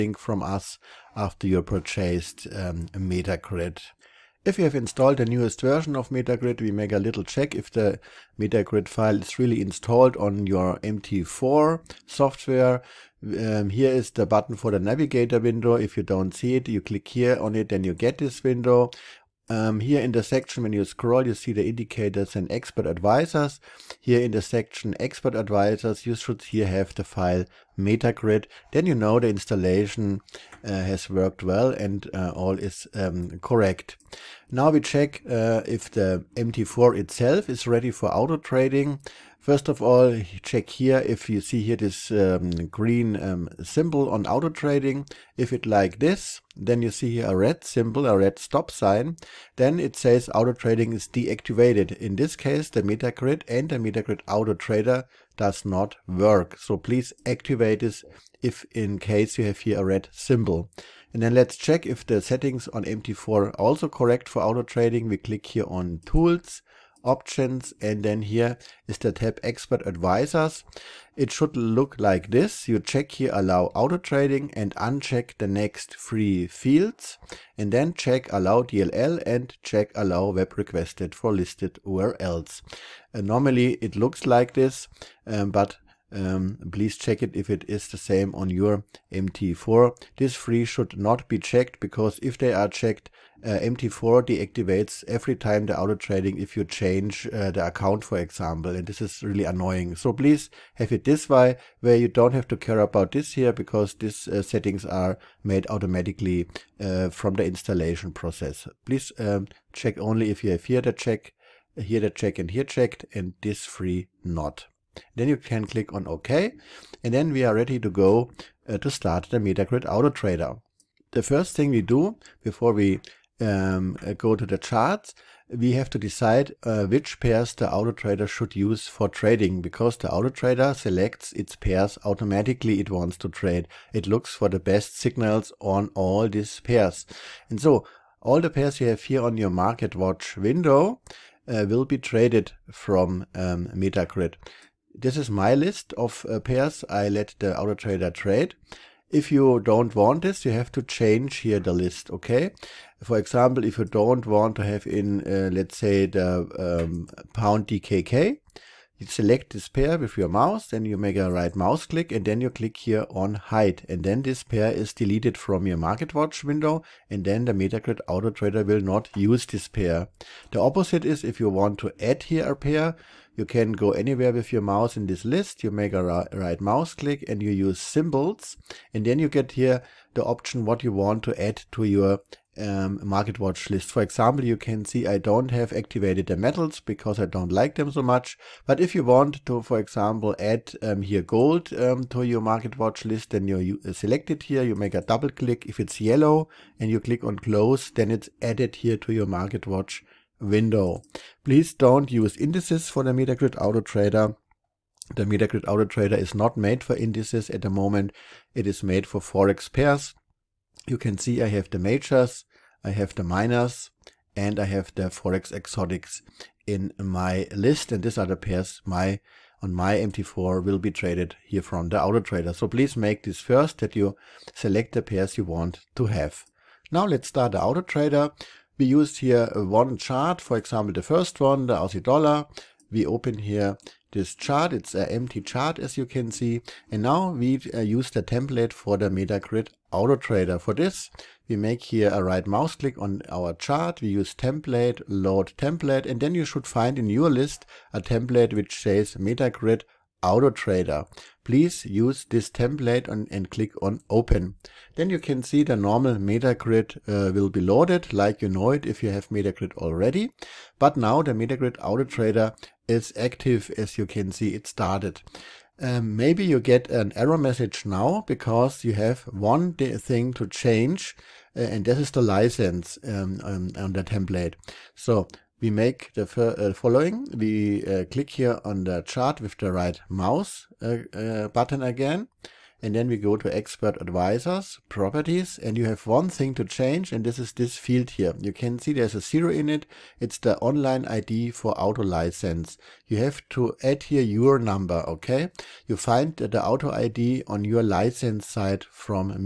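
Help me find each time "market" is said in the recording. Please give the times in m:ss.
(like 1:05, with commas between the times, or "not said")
2:19, 2:45, 3:03, 3:12, 3:19.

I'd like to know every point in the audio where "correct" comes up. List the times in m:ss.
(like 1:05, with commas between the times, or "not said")
0:33, 1:03.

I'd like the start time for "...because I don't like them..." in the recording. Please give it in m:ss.
3:06.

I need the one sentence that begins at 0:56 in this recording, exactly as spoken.
So please activate this if in case you have here a red symbol.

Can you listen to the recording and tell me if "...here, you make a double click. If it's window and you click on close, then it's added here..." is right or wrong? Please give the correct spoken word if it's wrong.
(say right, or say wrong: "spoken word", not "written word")
wrong: "yellow", not "window".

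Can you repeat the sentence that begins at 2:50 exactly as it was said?
The opposite is if you want to add here a pair, you can go anywhere with your mouse in this list.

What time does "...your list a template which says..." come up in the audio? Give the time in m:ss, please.
4:07.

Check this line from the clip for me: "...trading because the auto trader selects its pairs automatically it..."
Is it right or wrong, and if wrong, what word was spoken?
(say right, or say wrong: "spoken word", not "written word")
right.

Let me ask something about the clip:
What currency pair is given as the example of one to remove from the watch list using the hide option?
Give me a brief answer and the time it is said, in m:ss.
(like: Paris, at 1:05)
Pound DKK, at 2:37.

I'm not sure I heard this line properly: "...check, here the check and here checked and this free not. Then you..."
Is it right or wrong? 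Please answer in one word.
right.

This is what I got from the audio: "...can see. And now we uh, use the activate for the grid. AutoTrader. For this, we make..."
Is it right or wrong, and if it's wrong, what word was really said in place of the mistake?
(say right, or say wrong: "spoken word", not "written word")
wrong: "template", not "activate".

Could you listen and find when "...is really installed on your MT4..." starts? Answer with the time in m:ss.
0:09.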